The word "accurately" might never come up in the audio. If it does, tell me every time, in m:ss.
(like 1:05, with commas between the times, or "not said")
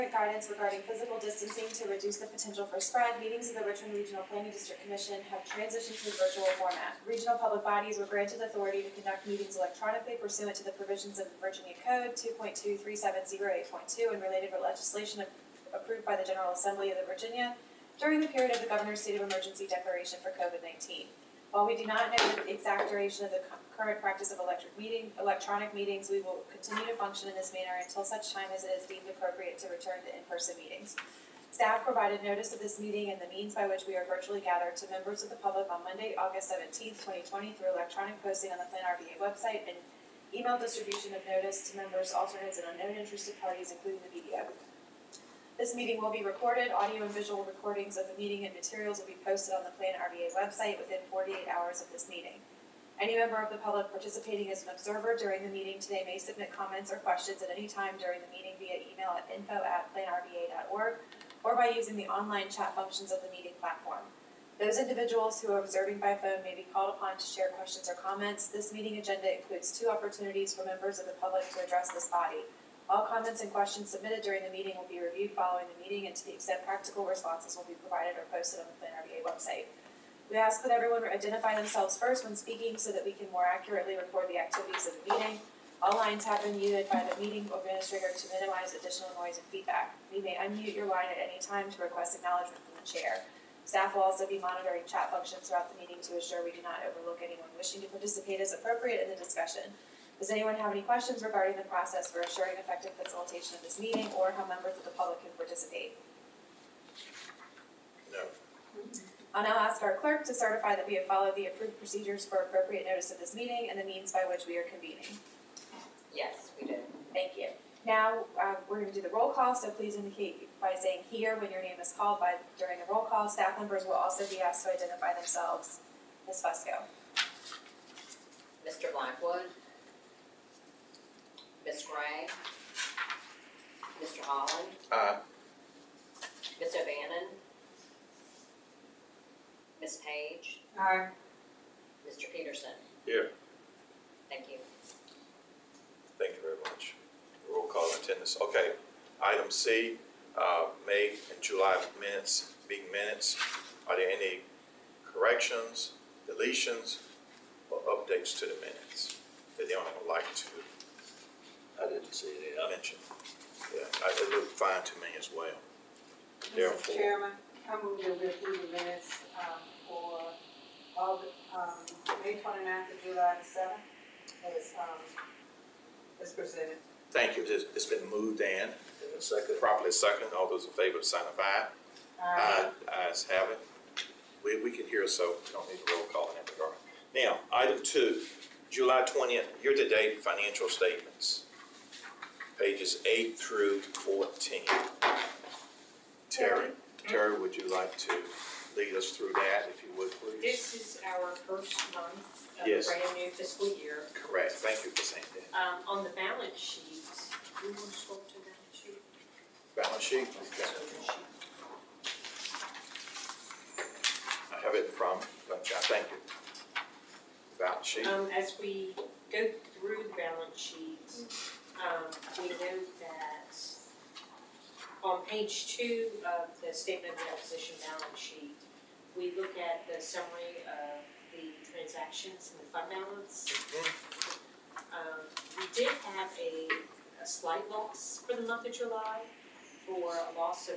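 1:23.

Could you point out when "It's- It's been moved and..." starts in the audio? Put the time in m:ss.
2:57.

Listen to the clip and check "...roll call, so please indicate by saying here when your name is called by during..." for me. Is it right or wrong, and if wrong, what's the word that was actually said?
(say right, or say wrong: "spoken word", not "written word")
right.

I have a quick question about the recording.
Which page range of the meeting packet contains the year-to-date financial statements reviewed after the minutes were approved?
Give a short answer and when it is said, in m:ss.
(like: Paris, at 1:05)
8 through 14, at 3:12.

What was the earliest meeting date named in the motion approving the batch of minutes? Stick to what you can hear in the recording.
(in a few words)
May 29th.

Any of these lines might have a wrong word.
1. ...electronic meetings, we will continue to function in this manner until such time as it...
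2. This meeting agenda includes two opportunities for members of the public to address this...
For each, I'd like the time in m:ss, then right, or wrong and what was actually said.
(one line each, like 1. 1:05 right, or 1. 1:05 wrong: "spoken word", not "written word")
1. 0:25 right
2. 1:08 right.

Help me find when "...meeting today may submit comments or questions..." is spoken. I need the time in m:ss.
0:55.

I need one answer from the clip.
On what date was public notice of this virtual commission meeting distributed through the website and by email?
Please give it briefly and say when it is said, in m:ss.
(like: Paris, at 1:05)
August 17, 2020, at 0:36.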